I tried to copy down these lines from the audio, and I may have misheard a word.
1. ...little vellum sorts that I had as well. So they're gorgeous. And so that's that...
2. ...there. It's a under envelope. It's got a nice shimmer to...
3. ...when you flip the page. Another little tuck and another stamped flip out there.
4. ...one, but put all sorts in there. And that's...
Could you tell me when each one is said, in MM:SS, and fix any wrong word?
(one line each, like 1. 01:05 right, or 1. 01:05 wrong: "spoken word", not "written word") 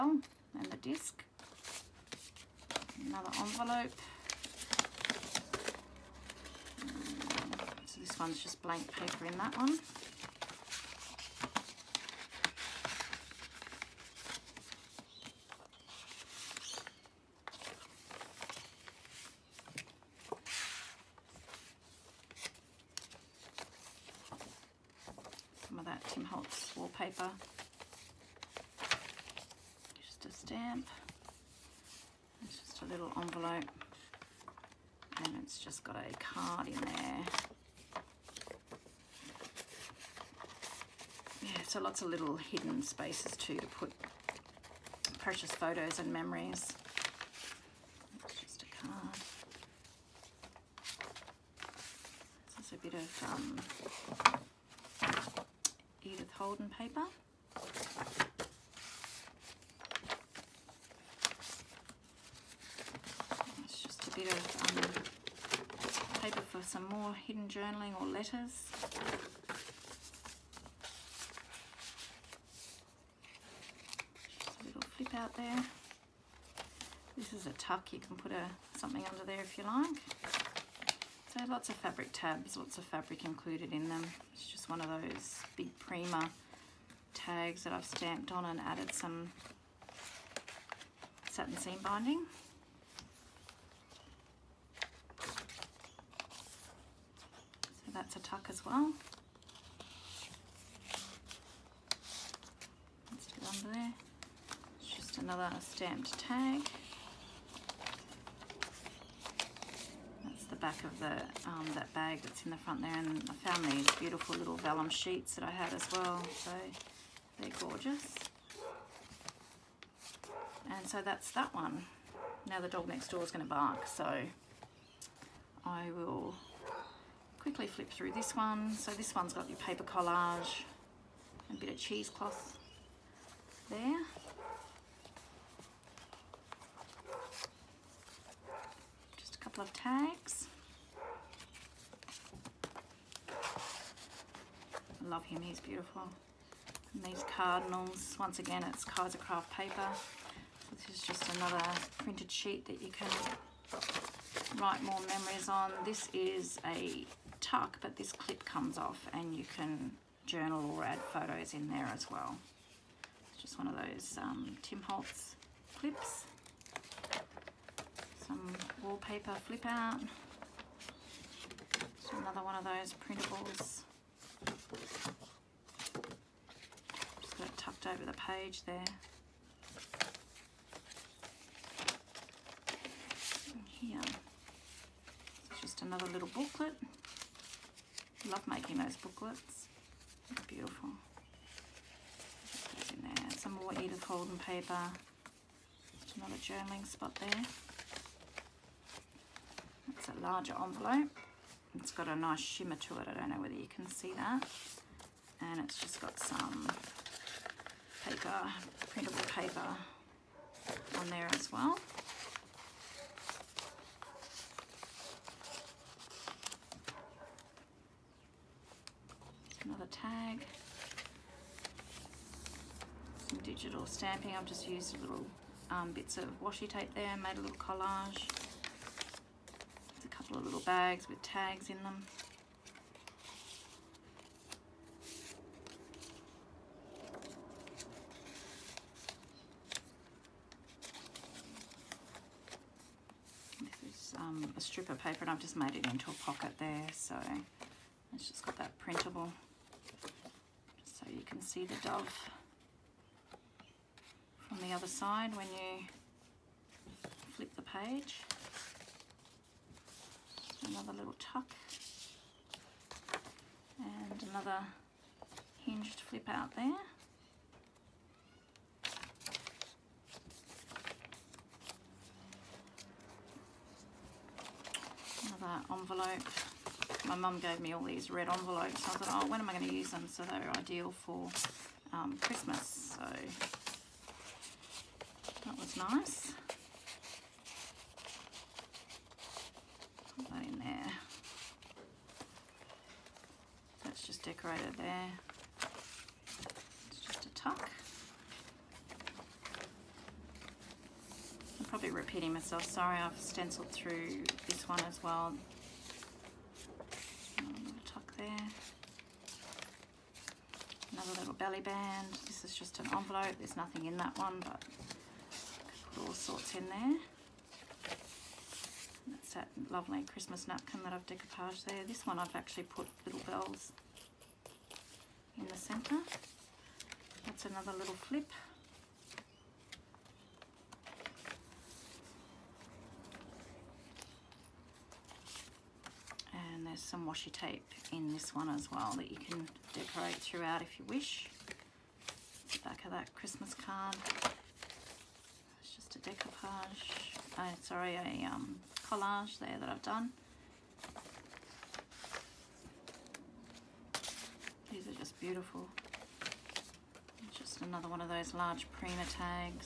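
1. 01:54 wrong: "sheets", not "sorts"
2. 03:17 wrong: "larger", not "under"
3. 04:15 wrong: "hinged", not "stamped"
4. 05:14 right.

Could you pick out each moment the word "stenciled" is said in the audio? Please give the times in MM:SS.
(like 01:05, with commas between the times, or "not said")
05:03.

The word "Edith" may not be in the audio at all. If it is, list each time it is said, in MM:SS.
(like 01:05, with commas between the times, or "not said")
00:56, 03:13.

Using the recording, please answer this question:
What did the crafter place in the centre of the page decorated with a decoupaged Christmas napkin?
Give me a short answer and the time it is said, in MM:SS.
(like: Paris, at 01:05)
little bells, at 05:23.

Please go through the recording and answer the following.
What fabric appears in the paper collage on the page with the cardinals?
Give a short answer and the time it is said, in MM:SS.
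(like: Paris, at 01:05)
cheesecloth, at 02:11.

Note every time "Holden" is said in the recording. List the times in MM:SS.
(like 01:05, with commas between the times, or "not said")
00:56, 03:14.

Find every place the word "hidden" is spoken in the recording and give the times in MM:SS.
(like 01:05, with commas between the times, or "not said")
00:42, 01:07.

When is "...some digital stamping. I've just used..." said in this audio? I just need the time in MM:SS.
03:43.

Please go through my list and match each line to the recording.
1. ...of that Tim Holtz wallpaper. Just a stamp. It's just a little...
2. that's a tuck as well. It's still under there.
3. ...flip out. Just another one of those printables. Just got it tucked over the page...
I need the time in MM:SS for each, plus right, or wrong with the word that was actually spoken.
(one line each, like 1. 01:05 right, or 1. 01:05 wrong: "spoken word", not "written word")
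1. 00:25 right
2. 01:37 right
3. 02:49 right.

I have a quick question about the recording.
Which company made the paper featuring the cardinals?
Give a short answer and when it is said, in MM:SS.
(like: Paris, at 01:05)
Kaiser Craft, at 02:28.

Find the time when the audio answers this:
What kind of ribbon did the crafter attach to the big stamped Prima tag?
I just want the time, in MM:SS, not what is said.
01:31.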